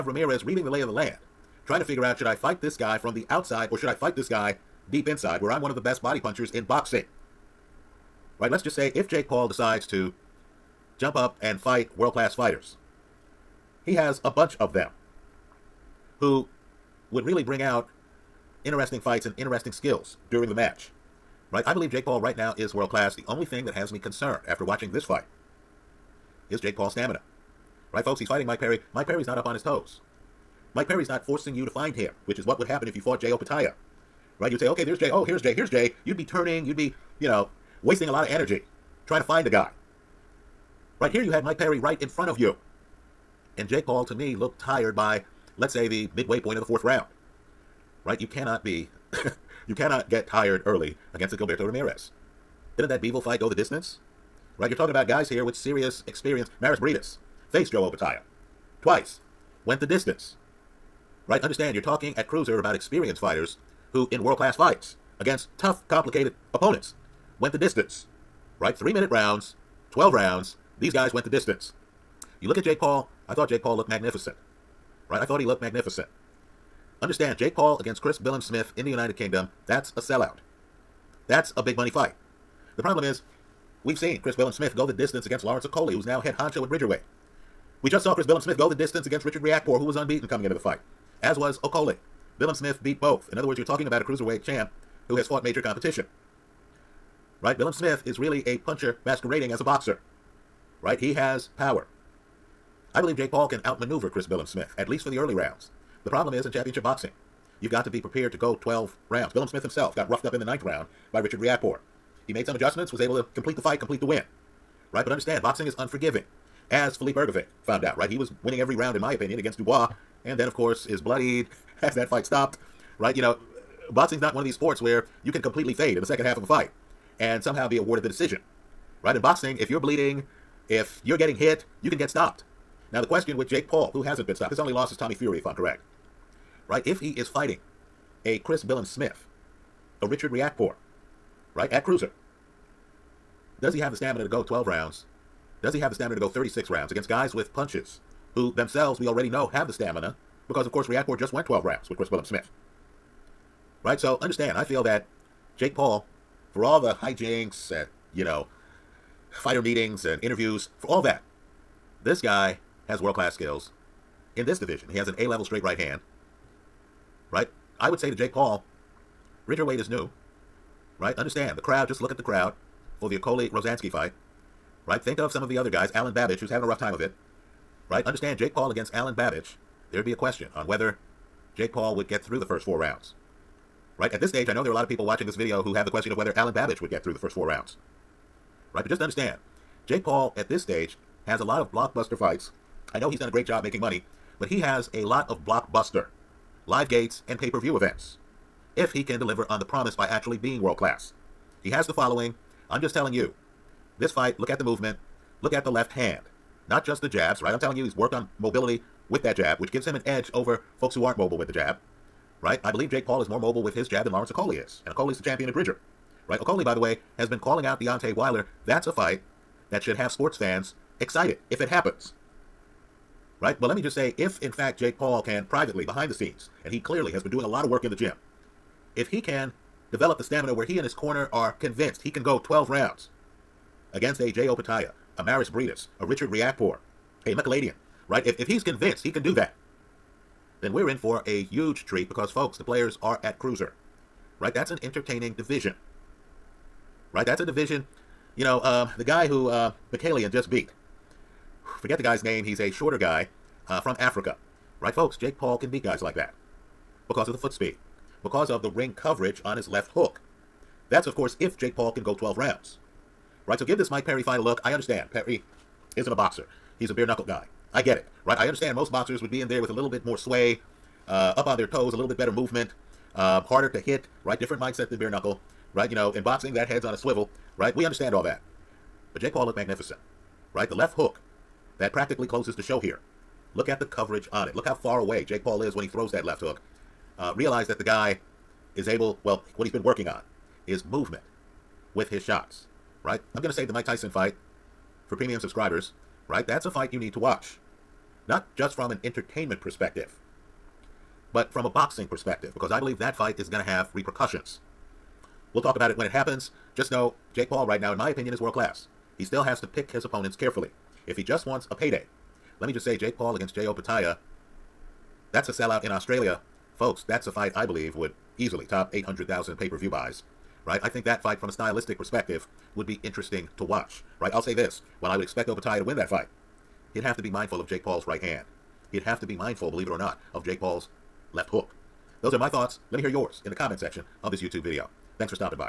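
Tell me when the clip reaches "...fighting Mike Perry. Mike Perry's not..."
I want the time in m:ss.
0:28.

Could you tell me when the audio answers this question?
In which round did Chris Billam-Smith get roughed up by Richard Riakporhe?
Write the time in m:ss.
1:50.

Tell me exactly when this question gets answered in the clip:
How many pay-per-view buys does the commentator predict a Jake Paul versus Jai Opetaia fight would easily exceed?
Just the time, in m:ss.
5:18.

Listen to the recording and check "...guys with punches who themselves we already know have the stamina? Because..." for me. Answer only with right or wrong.
right.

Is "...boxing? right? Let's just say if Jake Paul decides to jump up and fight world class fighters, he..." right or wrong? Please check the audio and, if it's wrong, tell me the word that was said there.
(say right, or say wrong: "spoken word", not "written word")
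right.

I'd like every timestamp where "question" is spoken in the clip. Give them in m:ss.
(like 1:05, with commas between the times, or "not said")
2:13, 3:00, 3:05.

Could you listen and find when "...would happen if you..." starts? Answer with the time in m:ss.
0:32.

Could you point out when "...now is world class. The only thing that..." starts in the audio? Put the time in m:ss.
0:22.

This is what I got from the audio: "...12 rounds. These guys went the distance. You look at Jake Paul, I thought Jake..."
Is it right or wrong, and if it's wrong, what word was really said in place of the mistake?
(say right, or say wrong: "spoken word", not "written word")
right.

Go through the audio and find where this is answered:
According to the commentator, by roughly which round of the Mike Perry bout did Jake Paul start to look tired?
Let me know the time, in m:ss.
0:46.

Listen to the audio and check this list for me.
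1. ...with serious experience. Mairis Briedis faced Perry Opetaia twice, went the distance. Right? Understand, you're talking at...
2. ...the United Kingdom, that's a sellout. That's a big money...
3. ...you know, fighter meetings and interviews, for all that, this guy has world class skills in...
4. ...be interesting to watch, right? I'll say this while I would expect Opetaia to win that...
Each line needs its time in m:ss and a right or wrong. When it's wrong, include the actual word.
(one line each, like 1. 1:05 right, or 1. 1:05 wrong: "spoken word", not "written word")
1. 0:55 wrong: "Joe", not "Perry"
2. 1:18 right
3. 2:38 right
4. 5:22 right.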